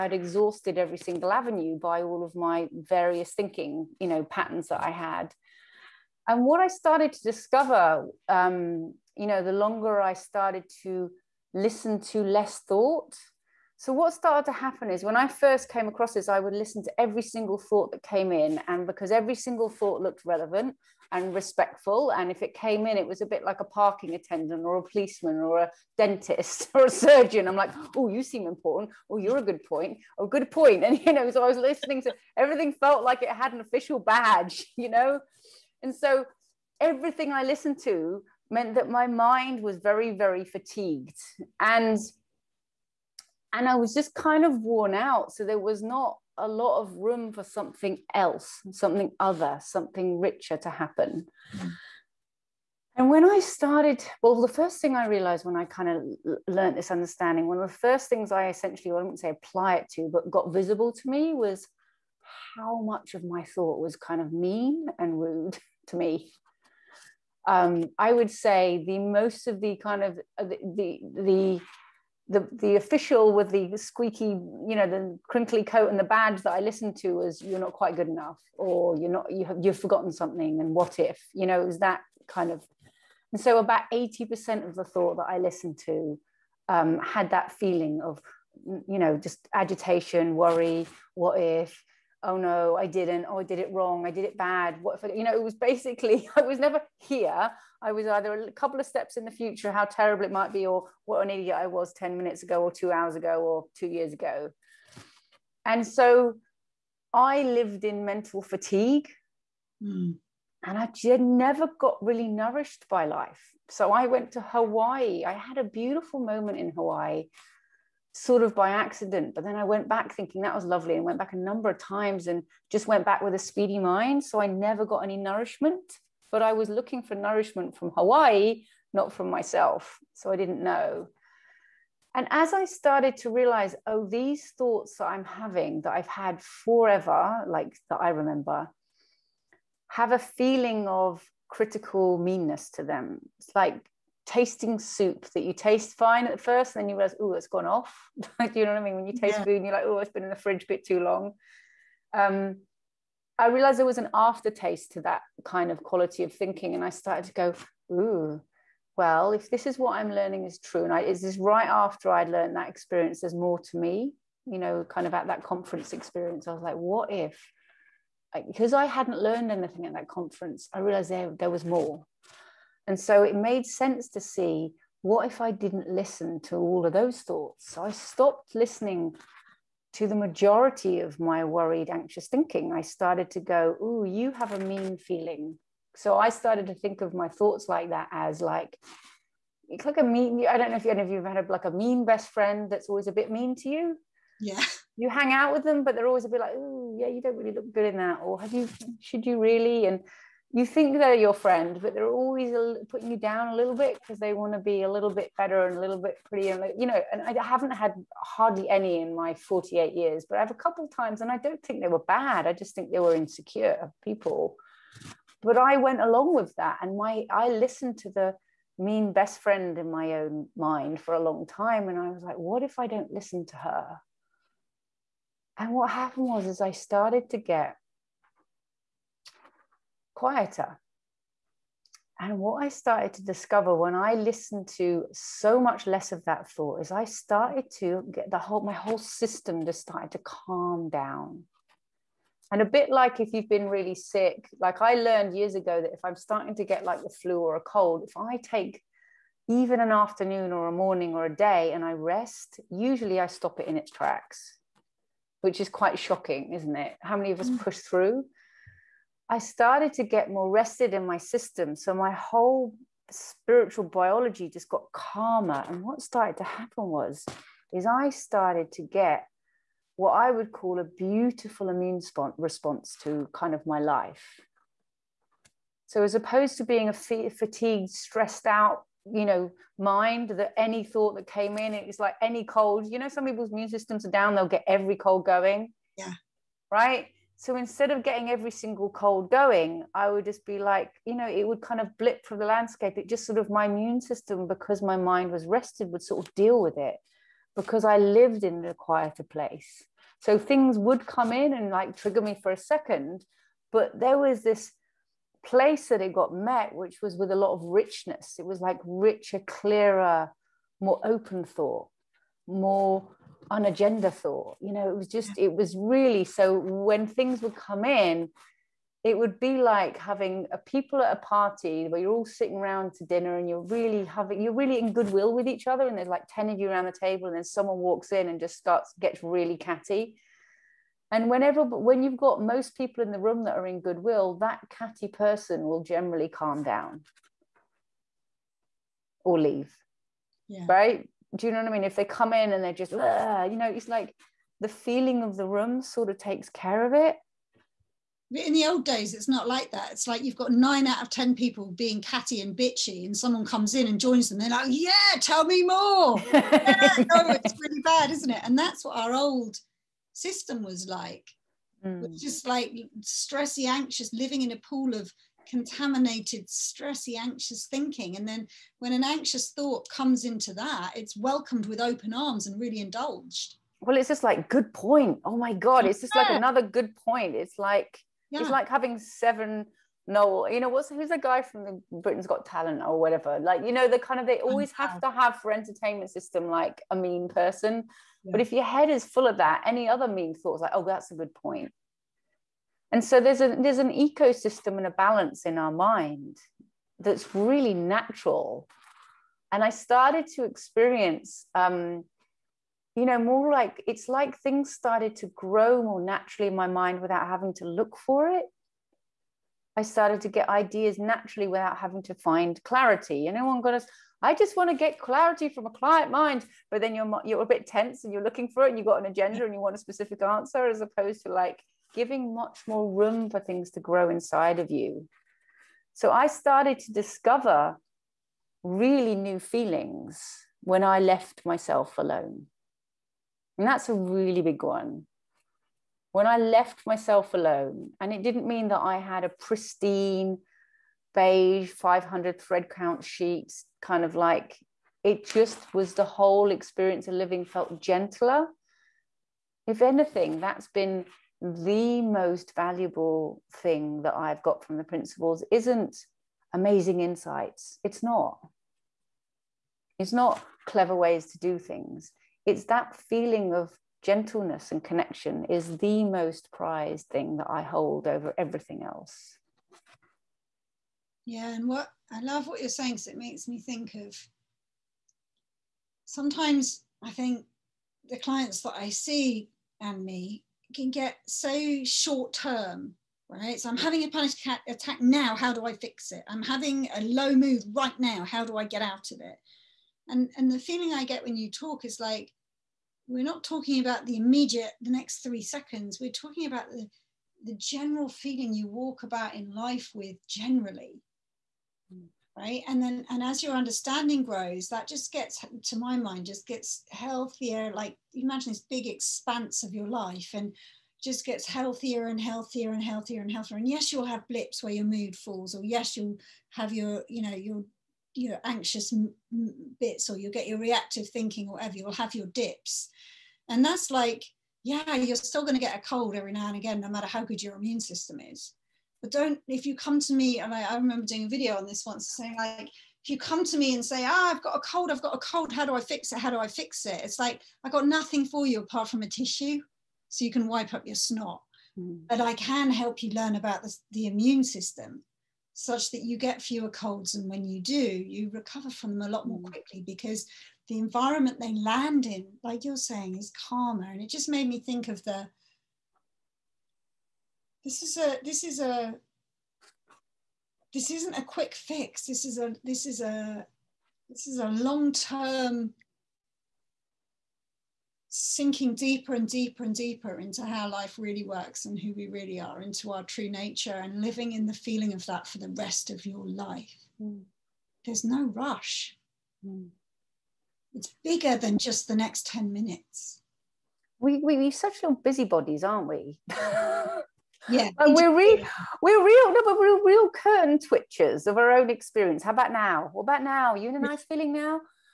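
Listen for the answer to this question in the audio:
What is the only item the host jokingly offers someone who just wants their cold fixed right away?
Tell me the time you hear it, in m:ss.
8:59.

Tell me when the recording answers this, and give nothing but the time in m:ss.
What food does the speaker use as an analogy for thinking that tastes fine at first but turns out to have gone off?
2:24.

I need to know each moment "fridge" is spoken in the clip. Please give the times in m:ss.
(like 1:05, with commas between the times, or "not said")
2:30.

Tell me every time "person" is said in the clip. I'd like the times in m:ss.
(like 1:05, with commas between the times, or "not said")
5:35, 6:27.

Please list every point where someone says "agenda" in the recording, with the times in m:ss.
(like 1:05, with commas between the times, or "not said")
5:13, 6:59.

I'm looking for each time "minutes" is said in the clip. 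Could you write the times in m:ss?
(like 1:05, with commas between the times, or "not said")
1:42, 9:42.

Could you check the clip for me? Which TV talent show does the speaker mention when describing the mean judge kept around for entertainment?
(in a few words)
Britain's Got Talent.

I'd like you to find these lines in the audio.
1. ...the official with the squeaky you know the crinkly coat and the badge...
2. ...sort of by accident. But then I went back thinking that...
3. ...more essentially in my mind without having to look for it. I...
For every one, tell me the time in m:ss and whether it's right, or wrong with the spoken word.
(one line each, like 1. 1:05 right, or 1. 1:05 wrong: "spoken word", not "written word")
1. 1:12 right
2. 1:58 right
3. 6:45 wrong: "naturally", not "essentially".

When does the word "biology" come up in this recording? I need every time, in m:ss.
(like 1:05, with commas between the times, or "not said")
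4:23.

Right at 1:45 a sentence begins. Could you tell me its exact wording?
And so I lived in mental fatigue.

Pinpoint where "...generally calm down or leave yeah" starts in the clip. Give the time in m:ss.
5:35.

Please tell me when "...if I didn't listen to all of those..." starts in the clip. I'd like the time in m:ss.
2:55.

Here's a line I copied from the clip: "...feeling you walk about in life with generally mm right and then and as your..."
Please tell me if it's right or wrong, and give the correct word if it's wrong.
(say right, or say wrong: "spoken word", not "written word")
right.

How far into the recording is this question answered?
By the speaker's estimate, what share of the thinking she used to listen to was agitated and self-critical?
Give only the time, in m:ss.
1:23.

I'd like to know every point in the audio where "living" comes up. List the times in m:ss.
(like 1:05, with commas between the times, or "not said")
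6:04, 7:27, 9:33.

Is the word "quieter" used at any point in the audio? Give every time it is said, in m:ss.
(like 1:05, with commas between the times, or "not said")
3:50, 4:58.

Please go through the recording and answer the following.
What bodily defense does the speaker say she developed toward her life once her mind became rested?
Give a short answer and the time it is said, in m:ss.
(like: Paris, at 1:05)
Immune response, at 4:31.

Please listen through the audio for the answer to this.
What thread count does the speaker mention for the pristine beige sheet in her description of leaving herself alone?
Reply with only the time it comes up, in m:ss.
7:21.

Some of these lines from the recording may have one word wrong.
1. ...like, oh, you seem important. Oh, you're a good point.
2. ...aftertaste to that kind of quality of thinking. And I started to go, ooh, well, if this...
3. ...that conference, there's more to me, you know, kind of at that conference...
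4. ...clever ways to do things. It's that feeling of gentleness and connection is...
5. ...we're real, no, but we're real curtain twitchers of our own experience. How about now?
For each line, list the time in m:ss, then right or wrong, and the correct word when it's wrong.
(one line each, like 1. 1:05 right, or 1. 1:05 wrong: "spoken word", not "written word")
1. 0:27 right
2. 2:34 right
3. 2:42 wrong: "experience", not "conference"
4. 7:40 right
5. 9:48 right.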